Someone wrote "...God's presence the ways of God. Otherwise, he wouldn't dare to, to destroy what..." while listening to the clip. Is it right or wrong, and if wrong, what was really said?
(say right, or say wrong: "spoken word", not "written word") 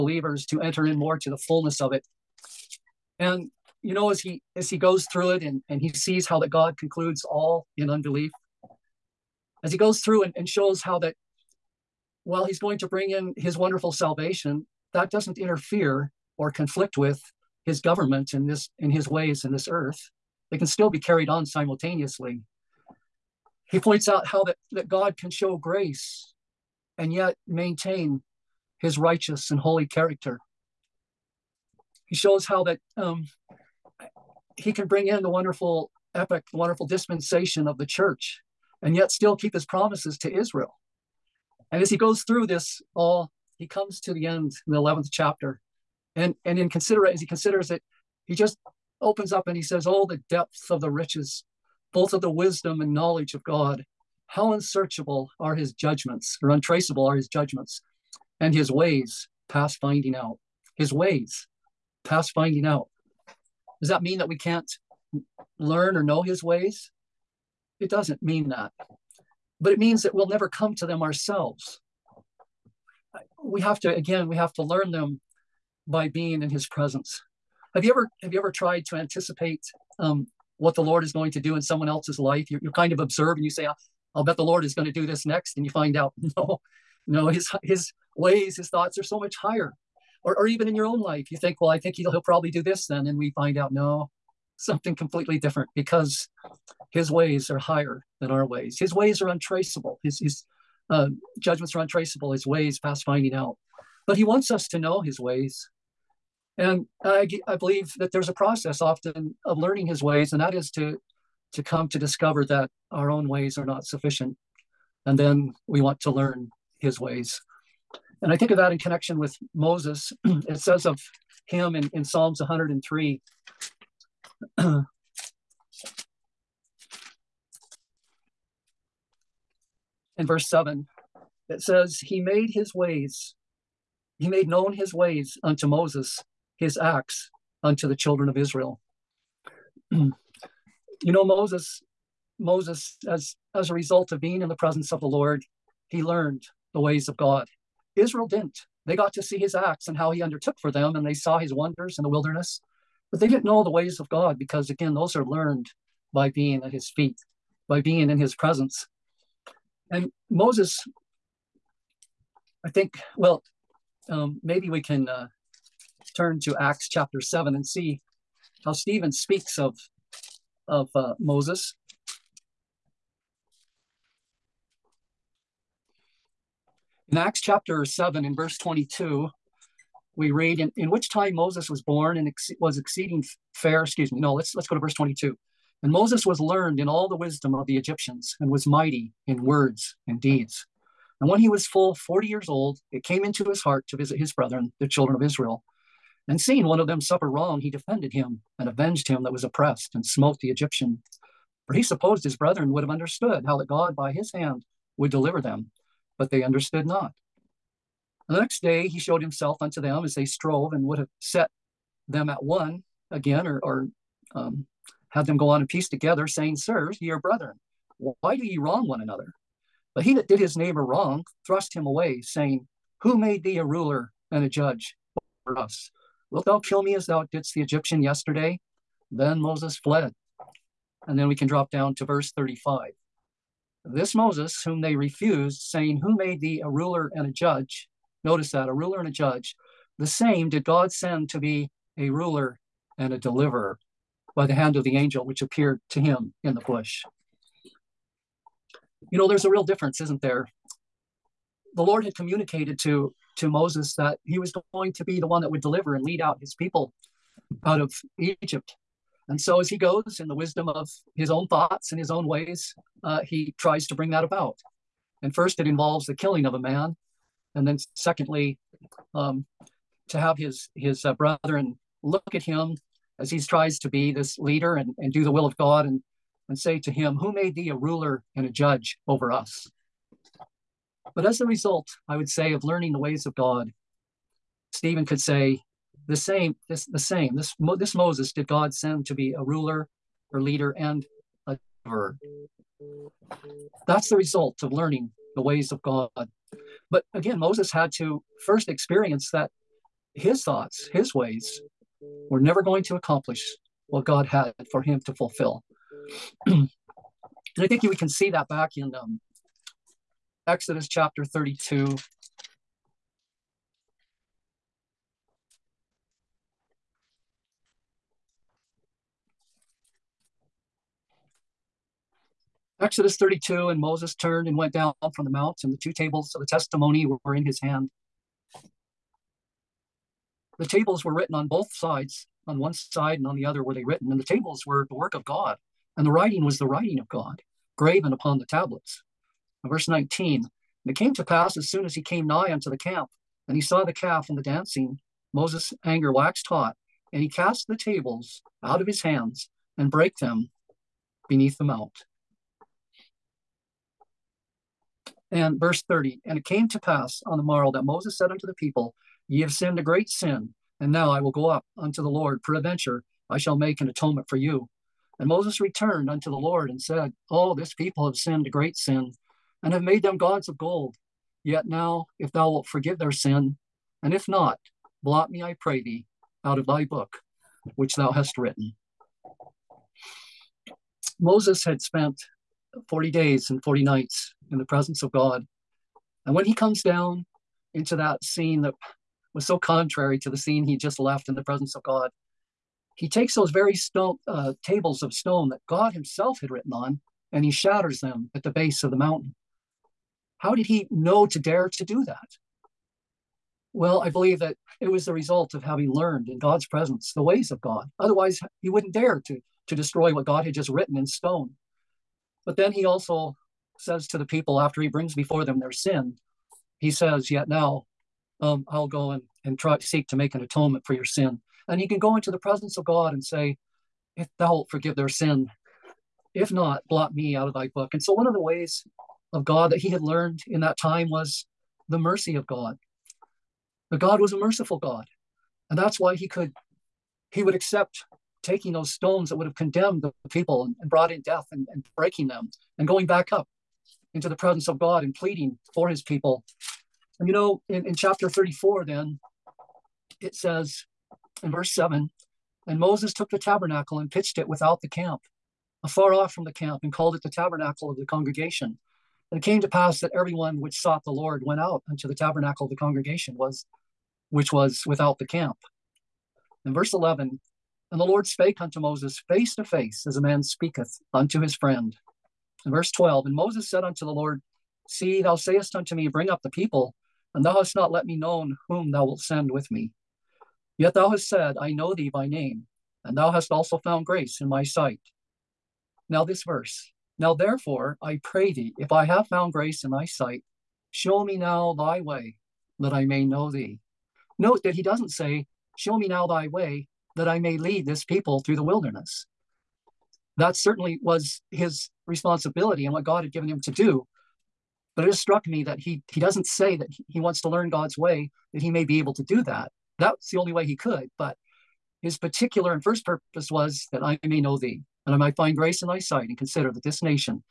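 right.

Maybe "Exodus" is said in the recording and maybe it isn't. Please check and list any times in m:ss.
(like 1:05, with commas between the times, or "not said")
5:10, 5:22.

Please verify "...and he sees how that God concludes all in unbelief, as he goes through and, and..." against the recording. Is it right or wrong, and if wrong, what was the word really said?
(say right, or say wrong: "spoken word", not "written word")
right.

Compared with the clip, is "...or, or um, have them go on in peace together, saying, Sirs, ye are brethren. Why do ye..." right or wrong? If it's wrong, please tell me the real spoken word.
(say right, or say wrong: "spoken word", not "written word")
right.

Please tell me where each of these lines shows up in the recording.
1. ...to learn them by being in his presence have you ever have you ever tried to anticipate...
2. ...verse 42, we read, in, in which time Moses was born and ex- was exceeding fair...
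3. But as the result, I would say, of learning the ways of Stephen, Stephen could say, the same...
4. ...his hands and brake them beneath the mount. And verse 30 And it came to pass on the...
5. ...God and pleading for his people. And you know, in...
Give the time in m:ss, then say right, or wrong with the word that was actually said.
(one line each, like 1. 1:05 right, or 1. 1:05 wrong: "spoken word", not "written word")
1. 1:14 right
2. 2:58 wrong: "22", not "42"
3. 4:41 wrong: "God", not "Stephen"
4. 5:48 right
5. 7:24 right.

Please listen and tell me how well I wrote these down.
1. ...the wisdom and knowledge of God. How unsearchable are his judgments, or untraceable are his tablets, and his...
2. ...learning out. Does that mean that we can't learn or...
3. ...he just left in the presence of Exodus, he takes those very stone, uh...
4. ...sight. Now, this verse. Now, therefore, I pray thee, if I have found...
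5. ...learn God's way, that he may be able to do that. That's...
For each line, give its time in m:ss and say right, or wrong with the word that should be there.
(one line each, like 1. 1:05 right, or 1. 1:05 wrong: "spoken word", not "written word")
1. 0:52 wrong: "judgments", not "tablets"
2. 1:02 wrong: "finding", not "learning"
3. 6:30 wrong: "God", not "Exodus"
4. 8:04 right
5. 8:27 right.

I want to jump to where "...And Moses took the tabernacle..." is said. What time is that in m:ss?
7:32.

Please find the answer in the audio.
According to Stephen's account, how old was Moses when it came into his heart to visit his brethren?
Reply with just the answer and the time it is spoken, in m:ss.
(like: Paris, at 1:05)
40, at 3:11.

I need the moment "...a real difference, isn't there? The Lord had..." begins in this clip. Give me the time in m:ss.
4:09.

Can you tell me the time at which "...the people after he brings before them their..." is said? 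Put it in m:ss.
6:54.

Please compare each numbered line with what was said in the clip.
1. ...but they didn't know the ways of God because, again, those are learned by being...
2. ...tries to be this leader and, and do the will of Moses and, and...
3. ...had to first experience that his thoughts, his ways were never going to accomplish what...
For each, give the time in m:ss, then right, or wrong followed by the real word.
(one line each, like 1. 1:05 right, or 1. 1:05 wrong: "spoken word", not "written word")
1. 2:33 right
2. 4:33 wrong: "God", not "Moses"
3. 4:57 right.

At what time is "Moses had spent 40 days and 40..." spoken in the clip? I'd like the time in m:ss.
6:21.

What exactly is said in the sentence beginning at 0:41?
And as he goes through this all, he comes to the end in the 11th chapter.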